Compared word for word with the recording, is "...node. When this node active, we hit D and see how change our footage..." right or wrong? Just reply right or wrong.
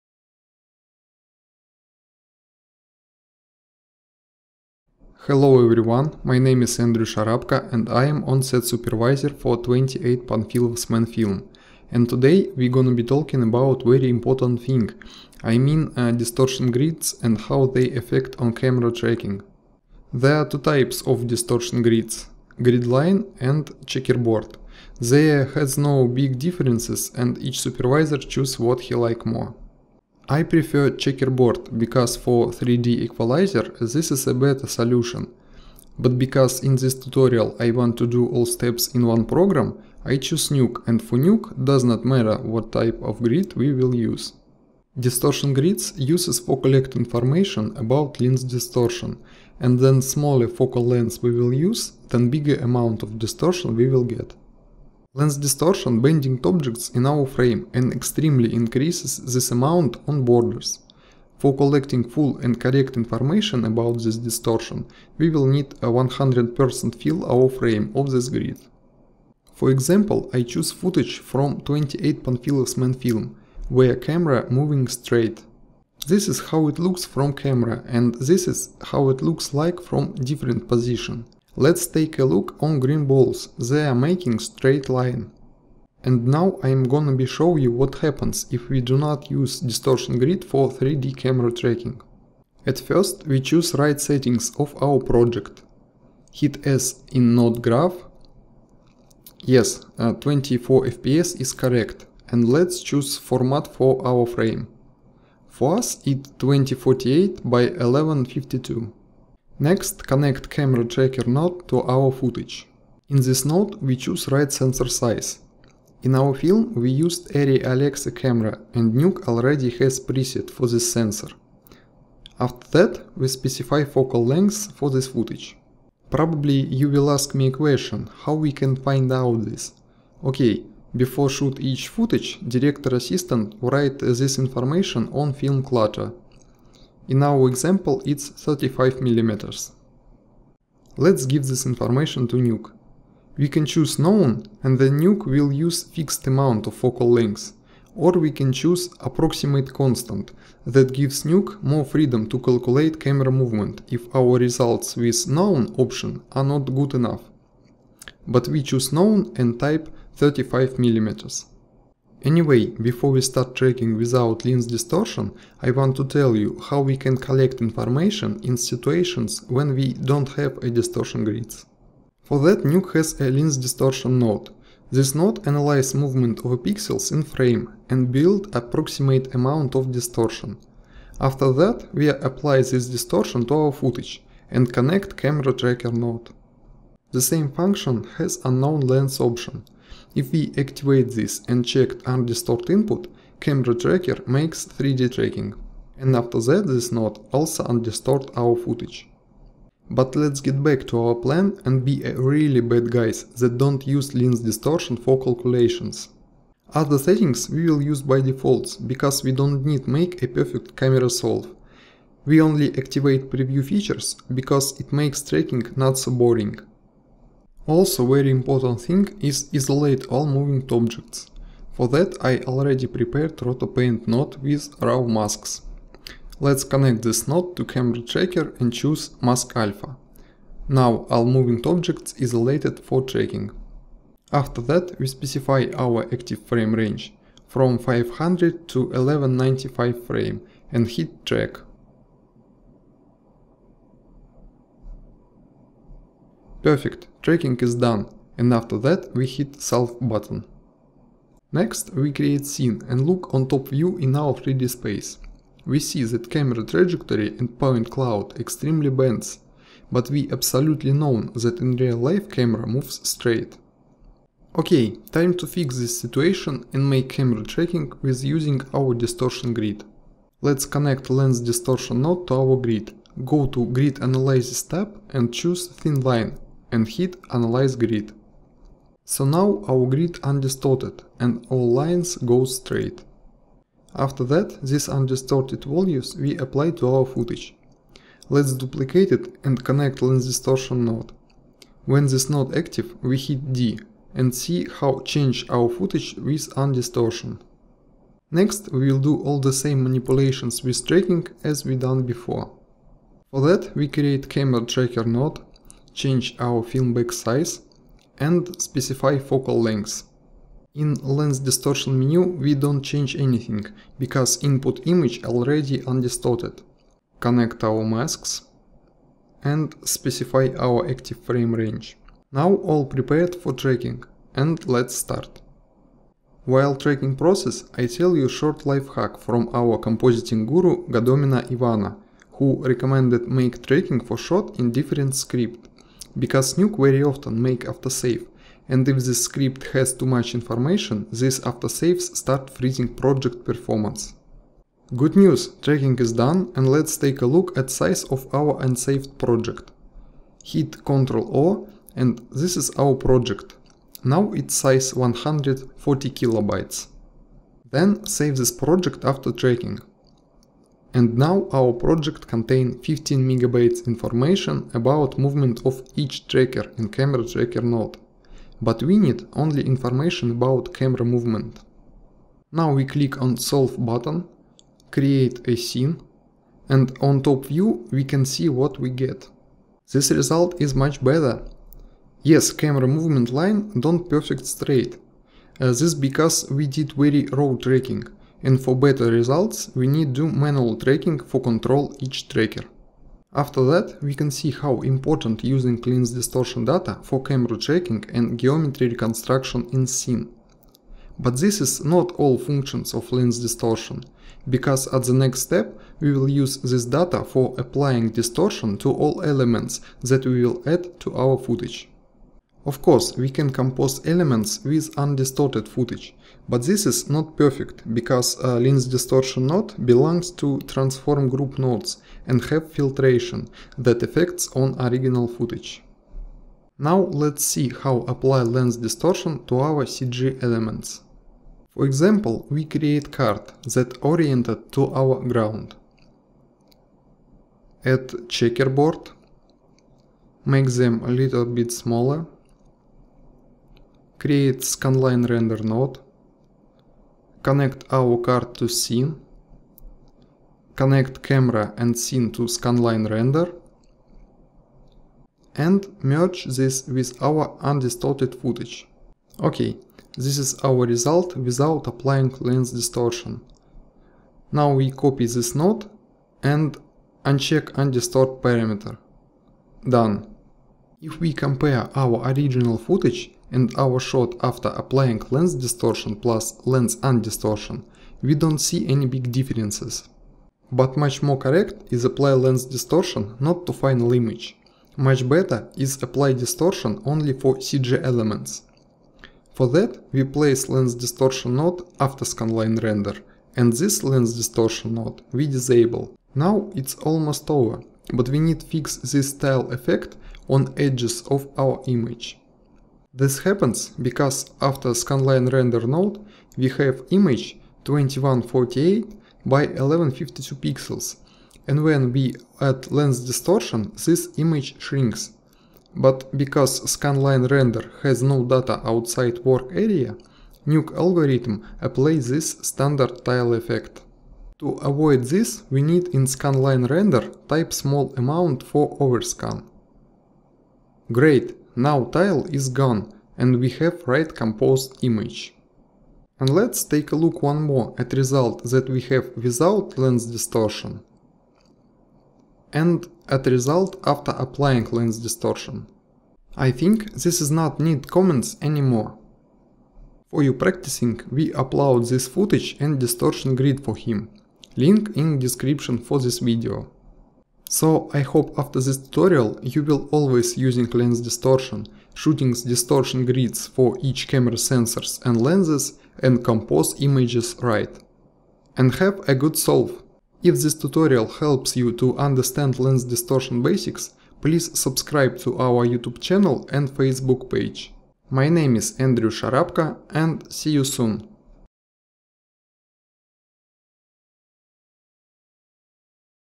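right.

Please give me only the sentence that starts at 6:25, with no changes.
Uh, this because we did very raw tracking and for better results we need to manual tracking for control each tracker.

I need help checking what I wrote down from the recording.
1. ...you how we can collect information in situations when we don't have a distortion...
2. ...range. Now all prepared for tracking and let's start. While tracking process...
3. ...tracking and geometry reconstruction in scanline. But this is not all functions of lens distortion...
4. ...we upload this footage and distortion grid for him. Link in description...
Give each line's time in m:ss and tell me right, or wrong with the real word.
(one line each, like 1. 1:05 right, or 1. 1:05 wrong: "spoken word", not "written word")
1. 2:46 right
2. 5:21 right
3. 6:37 wrong: "scene", not "scanline"
4. 9:11 right.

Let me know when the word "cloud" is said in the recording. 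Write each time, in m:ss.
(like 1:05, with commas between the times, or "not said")
4:17.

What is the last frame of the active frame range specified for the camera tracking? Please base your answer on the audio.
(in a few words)
1195.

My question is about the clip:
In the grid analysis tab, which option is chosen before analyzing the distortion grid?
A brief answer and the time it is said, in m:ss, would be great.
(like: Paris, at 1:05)
Thin line, at 4:35.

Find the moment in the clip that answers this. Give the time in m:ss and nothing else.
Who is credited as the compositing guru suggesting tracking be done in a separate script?
5:30.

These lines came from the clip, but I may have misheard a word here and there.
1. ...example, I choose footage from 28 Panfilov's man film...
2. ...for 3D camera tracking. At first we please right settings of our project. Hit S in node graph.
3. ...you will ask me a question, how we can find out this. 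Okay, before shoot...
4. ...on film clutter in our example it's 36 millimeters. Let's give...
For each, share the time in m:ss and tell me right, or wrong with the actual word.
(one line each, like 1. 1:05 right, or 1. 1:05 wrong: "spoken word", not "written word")
1. 1:09 right
2. 1:30 wrong: "choose", not "please"
3. 2:06 right
4. 2:15 wrong: "35", not "36".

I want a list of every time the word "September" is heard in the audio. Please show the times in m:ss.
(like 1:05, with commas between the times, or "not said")
not said.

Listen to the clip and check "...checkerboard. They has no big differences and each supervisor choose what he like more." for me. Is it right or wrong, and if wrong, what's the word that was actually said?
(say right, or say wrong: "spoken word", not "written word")
right.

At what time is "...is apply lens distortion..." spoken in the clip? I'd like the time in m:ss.
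8:01.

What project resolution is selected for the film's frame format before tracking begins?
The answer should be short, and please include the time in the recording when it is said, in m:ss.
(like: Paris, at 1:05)
2048 by 1152, at 1:46.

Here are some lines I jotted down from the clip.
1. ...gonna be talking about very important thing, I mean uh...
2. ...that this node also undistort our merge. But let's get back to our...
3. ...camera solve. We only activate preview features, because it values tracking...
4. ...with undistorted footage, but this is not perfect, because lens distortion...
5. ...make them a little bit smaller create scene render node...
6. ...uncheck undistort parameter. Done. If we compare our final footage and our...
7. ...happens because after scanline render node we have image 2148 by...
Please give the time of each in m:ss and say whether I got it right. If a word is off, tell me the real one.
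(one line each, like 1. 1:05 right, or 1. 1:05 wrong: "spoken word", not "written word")
1. 0:12 right
2. 3:16 wrong: "footage", not "merge"
3. 3:30 wrong: "makes", not "values"
4. 6:54 right
5. 7:20 wrong: "scanline", not "scene"
6. 7:47 wrong: "original", not "final"
7. 8:23 right.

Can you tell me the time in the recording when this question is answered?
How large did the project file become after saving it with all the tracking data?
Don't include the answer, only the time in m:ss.
6:02.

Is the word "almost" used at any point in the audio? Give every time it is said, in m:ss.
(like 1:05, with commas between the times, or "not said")
8:16.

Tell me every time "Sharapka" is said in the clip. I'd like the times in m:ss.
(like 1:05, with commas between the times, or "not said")
0:07, 9:39.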